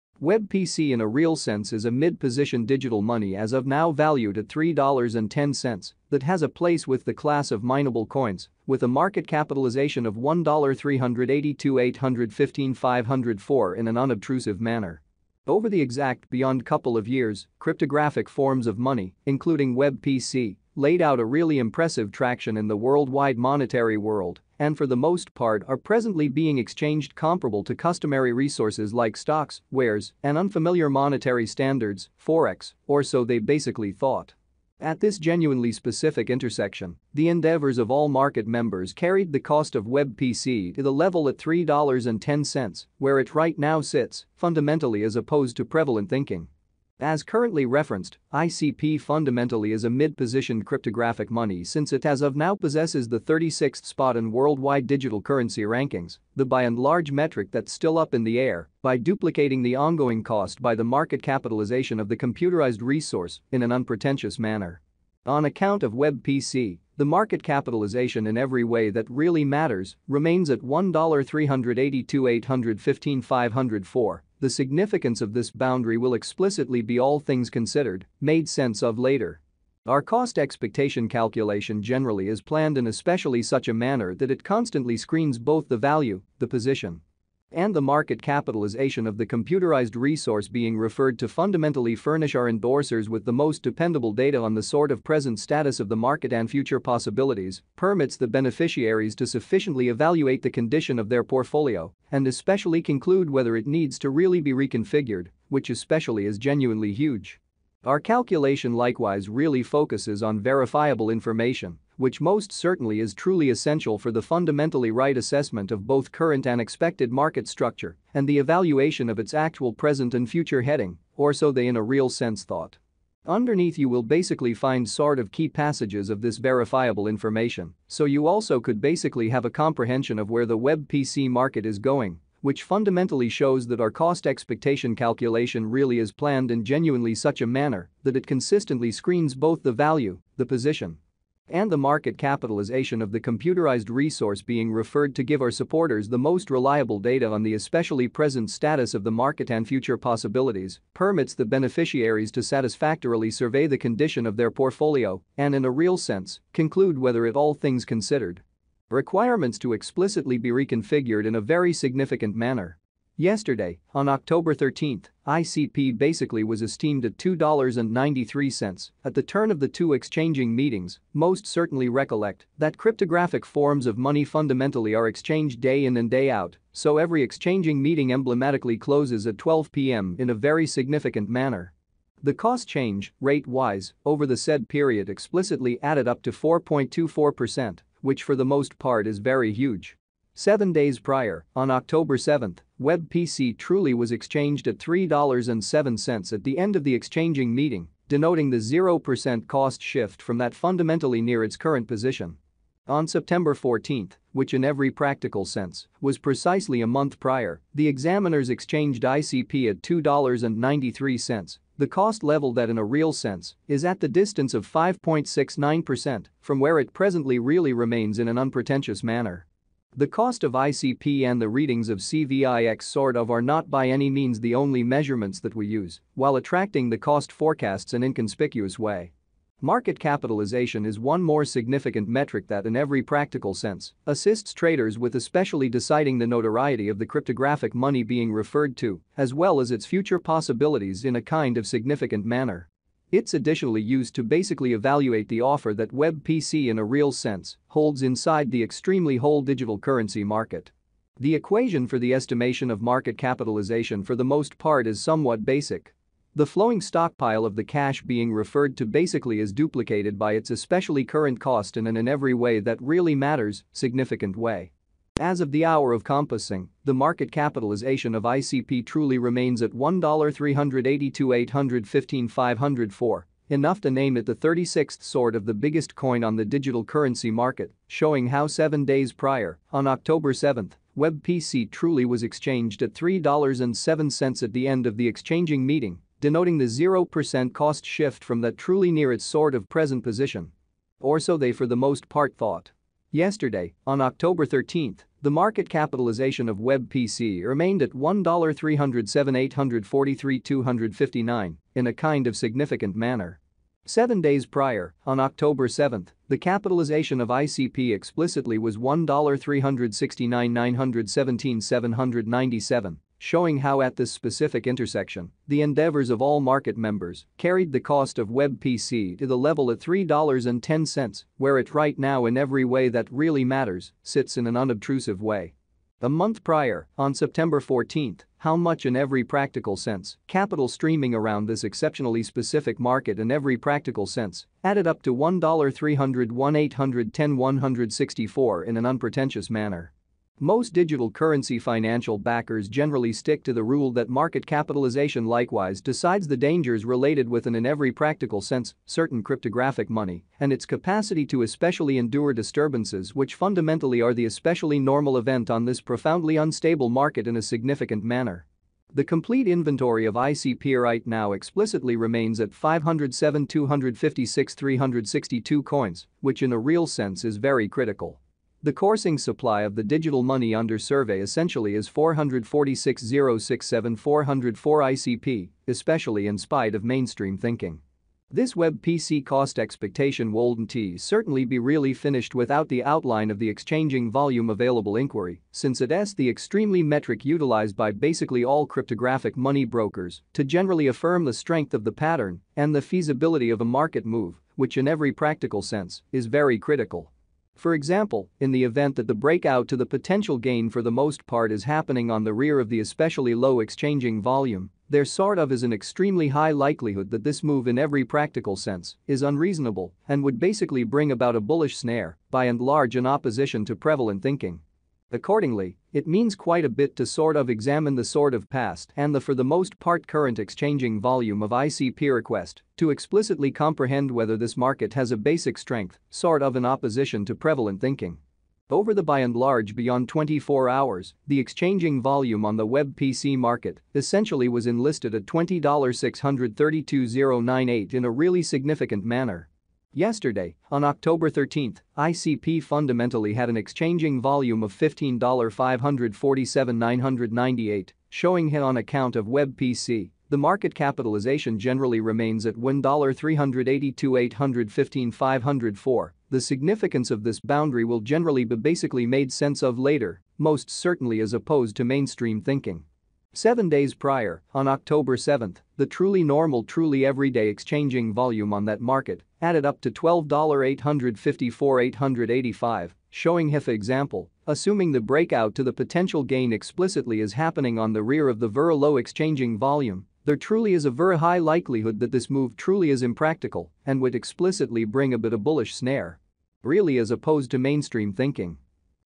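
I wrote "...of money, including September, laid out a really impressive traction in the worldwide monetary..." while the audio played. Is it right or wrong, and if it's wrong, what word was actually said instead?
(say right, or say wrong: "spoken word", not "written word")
wrong: "WebPC", not "September".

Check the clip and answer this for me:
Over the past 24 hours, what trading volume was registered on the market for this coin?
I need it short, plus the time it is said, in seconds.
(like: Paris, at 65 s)
$20,632,098, at 435 s.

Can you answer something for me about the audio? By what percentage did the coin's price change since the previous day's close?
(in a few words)
4.24%.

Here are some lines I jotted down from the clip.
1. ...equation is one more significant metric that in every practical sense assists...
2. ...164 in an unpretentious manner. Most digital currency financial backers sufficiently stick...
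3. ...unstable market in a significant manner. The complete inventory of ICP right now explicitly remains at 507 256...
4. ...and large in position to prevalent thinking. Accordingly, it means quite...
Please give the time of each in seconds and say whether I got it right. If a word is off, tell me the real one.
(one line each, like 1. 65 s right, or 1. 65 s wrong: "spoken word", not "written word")
1. 229 s wrong: "capitalization", not "equation"
2. 337 s wrong: "generally", not "sufficiently"
3. 356 s right
4. 412 s wrong: "opposition", not "position".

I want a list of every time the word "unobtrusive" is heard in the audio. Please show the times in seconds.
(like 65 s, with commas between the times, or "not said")
13 s, 324 s.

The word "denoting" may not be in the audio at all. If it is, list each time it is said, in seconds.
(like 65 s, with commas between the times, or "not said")
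198 s, 286 s.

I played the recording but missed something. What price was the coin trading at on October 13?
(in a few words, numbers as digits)
$2.93.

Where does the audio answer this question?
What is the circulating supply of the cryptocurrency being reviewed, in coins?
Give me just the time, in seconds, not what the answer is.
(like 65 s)
371 s.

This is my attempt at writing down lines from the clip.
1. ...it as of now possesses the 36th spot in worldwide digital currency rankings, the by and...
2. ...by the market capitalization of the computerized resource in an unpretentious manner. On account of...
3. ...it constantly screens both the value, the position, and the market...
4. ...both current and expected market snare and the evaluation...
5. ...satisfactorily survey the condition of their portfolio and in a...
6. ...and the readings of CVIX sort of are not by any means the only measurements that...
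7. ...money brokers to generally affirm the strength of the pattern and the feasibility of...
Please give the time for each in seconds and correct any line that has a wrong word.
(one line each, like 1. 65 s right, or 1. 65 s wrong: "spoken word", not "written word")
1. 51 s right
2. 60 s right
3. 84 s right
4. 115 s wrong: "structure", not "snare"
5. 152 s right
6. 221 s right
7. 389 s right.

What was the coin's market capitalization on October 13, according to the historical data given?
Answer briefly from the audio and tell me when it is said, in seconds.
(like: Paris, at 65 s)
$1,307,843,259, at 297 s.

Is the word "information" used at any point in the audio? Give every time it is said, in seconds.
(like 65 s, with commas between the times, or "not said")
111 s, 127 s.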